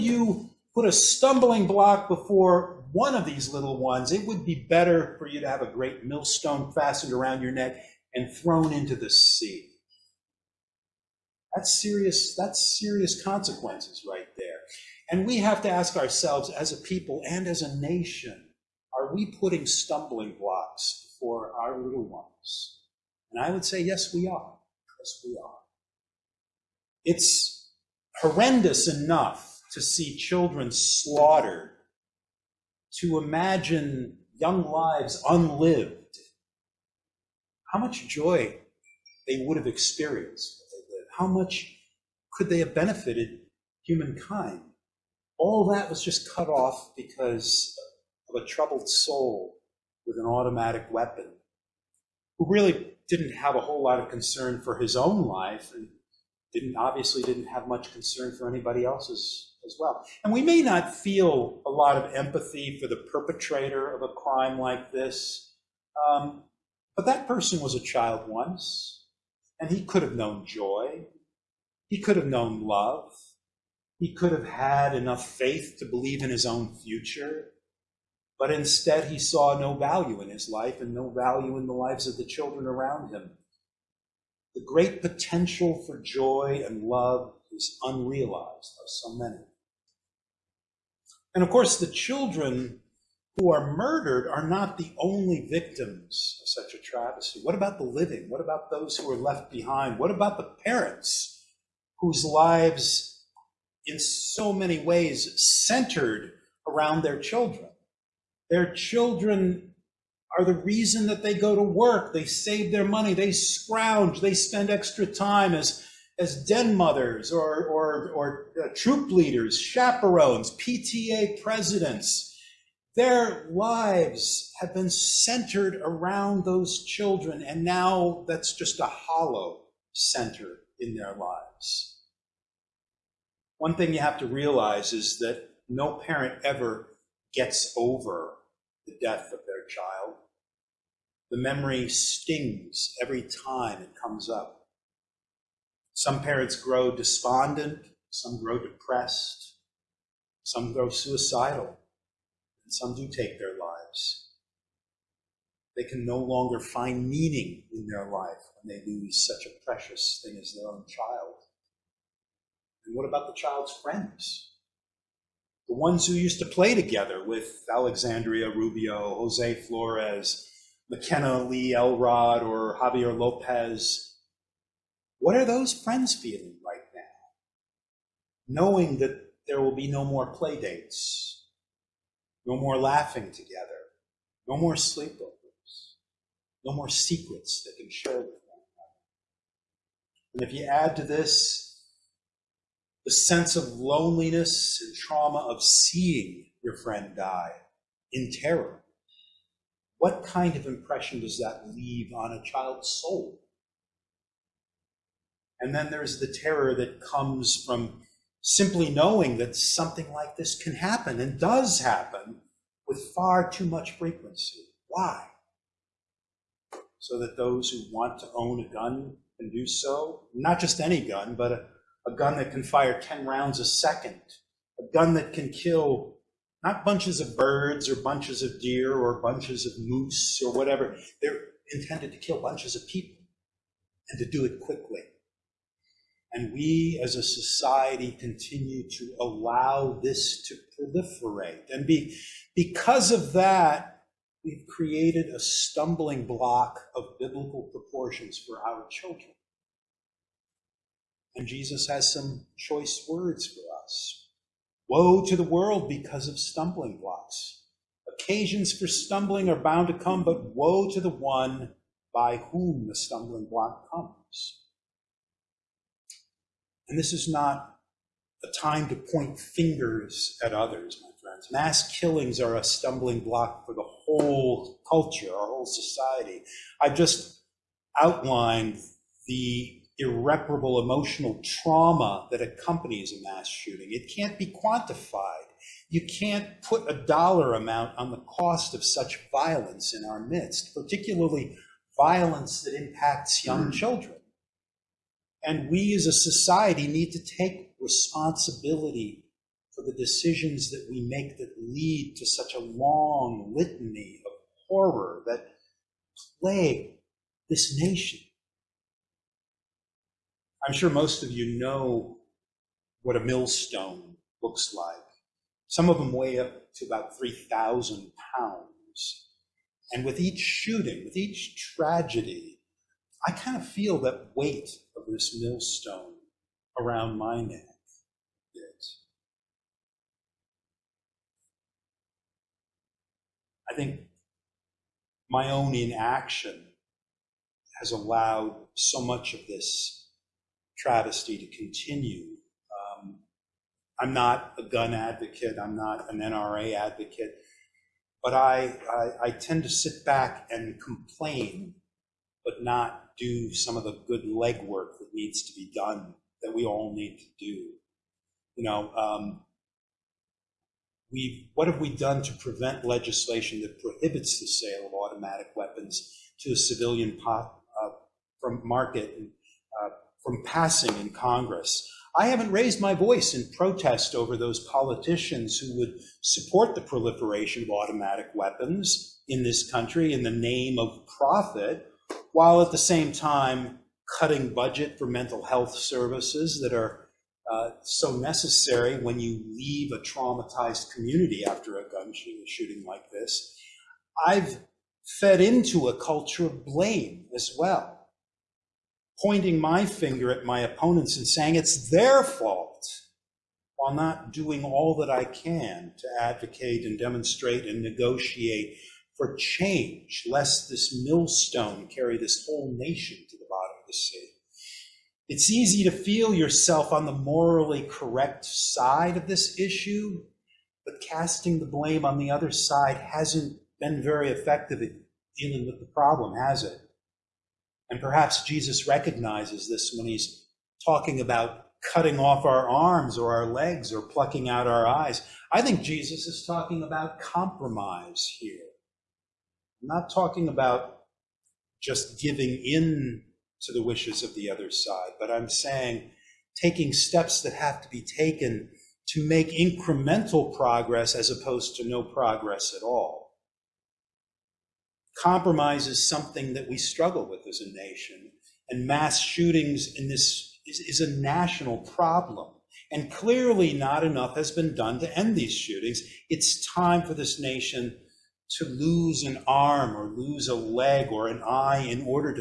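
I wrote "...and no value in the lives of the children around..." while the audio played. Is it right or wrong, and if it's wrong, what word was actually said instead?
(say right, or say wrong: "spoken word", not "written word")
right.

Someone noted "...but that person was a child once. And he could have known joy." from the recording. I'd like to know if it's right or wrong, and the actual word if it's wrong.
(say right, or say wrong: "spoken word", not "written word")
right.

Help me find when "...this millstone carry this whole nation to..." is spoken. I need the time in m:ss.
6:50.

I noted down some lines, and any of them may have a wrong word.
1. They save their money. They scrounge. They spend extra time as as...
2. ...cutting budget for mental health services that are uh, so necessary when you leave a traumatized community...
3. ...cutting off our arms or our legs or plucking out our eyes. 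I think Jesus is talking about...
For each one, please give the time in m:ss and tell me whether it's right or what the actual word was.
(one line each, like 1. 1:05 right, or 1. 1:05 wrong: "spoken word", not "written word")
1. 1:52 right
2. 6:24 right
3. 7:11 right.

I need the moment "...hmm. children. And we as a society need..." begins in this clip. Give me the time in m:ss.
4:53.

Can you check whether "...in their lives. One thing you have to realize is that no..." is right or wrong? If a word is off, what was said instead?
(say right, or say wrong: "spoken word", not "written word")
right.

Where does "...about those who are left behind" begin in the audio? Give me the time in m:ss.
1:38.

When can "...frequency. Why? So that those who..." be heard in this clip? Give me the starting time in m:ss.
3:33.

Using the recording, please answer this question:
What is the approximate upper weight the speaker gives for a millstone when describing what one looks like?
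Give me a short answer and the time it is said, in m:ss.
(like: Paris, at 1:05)
3,000 pounds, at 5:17.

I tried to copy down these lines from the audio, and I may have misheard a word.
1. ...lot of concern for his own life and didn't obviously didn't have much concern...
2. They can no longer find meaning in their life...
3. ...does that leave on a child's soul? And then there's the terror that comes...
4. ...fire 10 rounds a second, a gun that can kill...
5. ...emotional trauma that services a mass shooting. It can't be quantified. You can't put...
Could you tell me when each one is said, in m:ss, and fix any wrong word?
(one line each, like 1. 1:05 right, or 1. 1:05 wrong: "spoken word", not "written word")
1. 0:53 right
2. 2:35 right
3. 3:21 right
4. 3:42 right
5. 4:40 wrong: "accompanies", not "services".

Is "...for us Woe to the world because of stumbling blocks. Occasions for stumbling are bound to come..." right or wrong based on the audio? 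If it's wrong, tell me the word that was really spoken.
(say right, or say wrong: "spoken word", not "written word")
right.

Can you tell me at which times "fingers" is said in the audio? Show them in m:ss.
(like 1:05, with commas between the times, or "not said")
4:29, 6:39.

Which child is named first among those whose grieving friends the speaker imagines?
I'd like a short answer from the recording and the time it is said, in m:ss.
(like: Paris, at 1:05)
Alexandria Rubio, at 2:47.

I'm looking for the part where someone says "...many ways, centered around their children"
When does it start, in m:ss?
1:44.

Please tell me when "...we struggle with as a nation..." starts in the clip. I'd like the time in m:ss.
7:36.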